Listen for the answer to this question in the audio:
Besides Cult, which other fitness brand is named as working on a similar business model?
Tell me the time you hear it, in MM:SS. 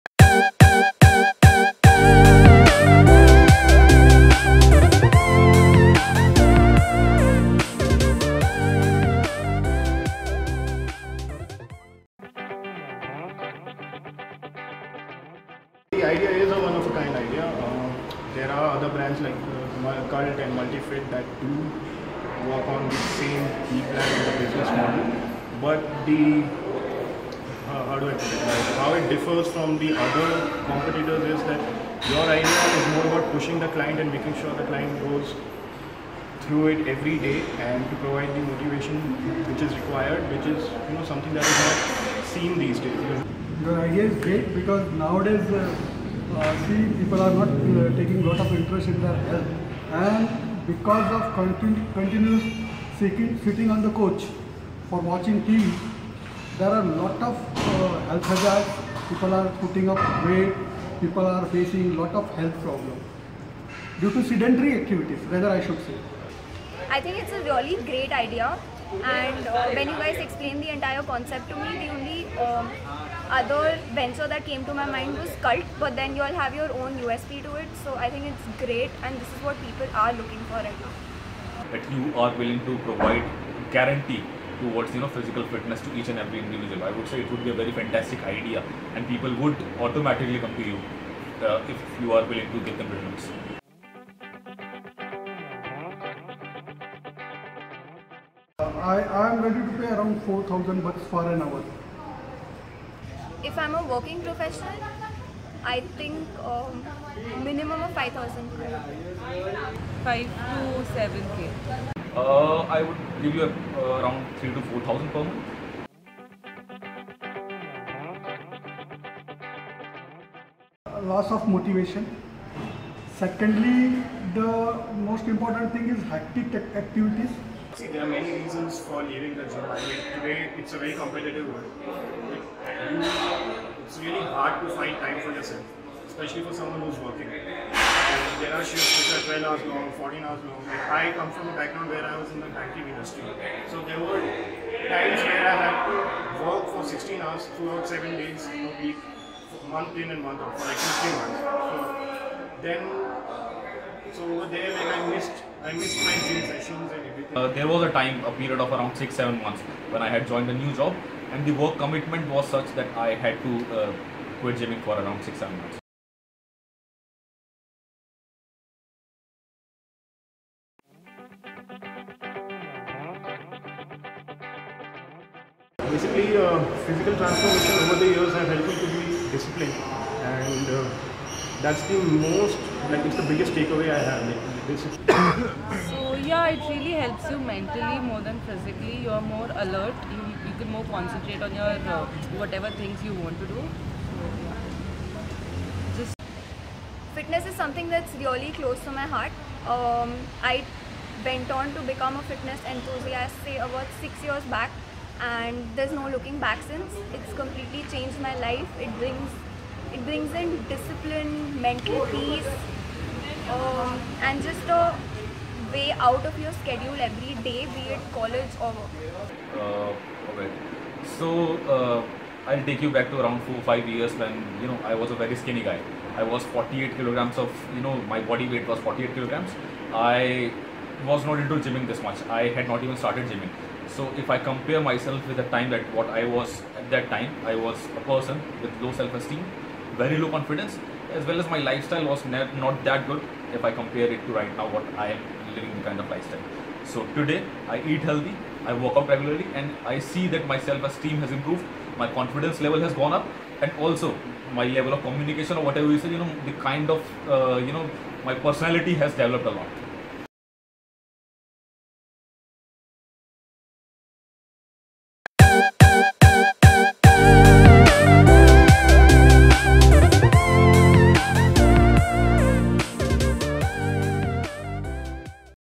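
00:20.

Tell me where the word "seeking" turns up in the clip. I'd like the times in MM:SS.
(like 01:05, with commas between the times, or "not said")
00:52.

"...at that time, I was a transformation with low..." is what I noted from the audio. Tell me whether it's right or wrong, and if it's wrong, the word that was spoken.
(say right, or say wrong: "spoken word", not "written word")
wrong: "person", not "transformation".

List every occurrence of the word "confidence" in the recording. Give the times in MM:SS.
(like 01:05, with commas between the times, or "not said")
04:00, 04:12.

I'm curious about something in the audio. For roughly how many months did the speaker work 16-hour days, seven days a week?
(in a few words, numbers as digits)
15.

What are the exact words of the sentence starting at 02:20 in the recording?
I come from a background where I was in the banking industry.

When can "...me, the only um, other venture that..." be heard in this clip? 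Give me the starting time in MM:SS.
01:11.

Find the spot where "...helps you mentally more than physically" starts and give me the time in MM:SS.
03:06.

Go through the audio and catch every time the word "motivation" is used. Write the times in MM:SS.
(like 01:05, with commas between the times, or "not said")
00:38, 02:01.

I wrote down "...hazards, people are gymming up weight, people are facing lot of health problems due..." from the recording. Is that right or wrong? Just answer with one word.
wrong.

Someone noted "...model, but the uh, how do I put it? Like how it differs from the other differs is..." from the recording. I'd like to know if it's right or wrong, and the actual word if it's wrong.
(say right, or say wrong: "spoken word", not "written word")
wrong: "competitors", not "differs".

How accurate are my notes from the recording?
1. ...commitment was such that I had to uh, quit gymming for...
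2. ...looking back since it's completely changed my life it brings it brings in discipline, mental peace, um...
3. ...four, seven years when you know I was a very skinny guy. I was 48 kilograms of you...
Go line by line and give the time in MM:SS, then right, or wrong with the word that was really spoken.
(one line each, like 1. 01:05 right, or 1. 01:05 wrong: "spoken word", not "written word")
1. 02:41 right
2. 03:26 right
3. 03:43 wrong: "five", not "seven".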